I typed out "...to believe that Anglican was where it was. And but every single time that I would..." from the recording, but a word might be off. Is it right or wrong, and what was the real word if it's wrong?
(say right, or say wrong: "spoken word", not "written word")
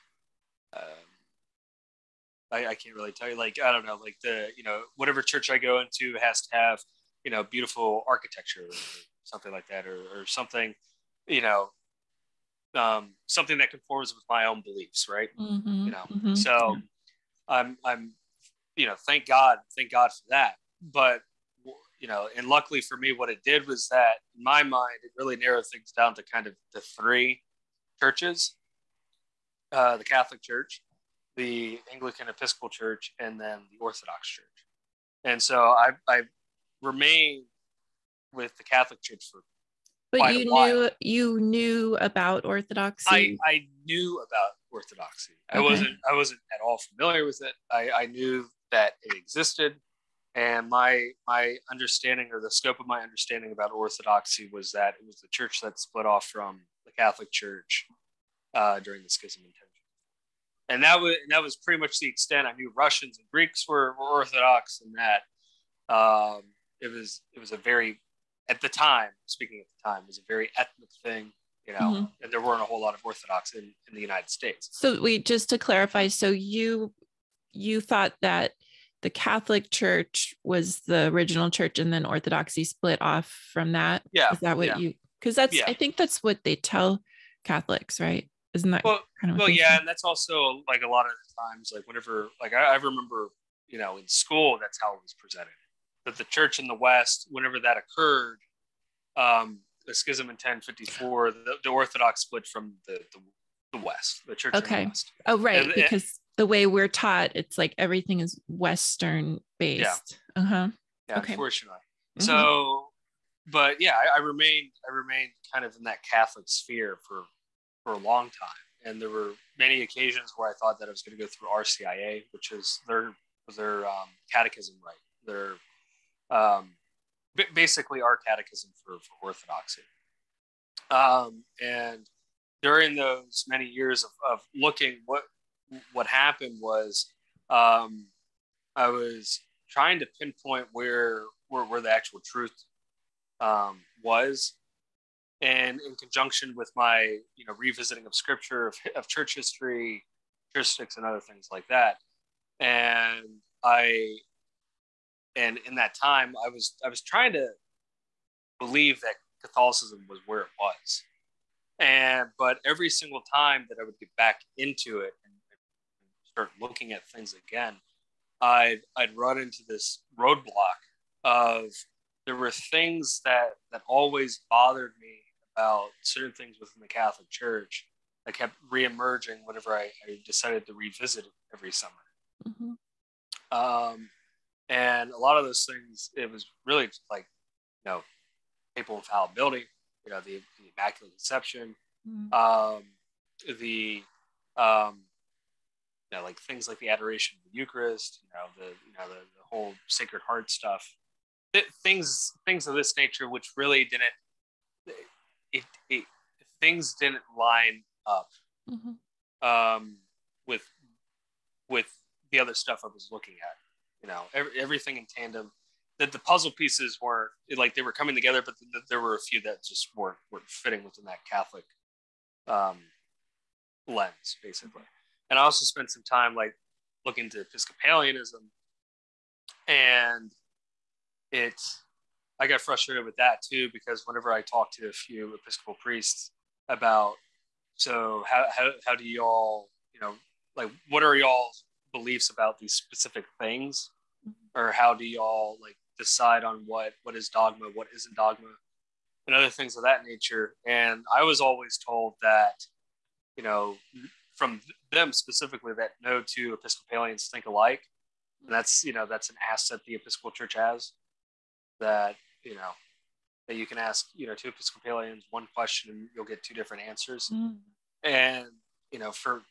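wrong: "Catholicism", not "Anglican".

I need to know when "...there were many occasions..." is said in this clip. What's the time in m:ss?
1:59.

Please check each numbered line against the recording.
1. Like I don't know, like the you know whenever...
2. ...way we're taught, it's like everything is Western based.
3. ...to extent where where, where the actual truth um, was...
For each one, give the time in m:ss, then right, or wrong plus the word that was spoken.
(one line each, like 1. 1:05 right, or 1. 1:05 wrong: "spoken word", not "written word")
1. 0:03 wrong: "whatever", not "whenever"
2. 1:46 right
3. 2:19 wrong: "pinpoint", not "extent".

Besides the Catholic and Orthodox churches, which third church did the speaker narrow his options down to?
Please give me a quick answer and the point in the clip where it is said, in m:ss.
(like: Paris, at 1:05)
Anglican Episcopal Church, at 0:31.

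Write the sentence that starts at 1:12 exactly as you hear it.
and there weren't a whole lot of Orthodox in, in the United States.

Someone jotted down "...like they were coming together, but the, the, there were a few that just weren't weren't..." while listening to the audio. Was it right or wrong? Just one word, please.
right.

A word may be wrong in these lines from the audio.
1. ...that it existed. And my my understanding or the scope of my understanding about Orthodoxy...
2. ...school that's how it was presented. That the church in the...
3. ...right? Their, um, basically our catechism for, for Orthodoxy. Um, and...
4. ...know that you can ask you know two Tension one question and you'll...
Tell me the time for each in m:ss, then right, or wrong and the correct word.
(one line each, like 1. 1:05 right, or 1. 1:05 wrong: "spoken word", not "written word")
1. 0:48 right
2. 1:34 right
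3. 2:04 right
4. 4:22 wrong: "Episcopalians", not "Tension".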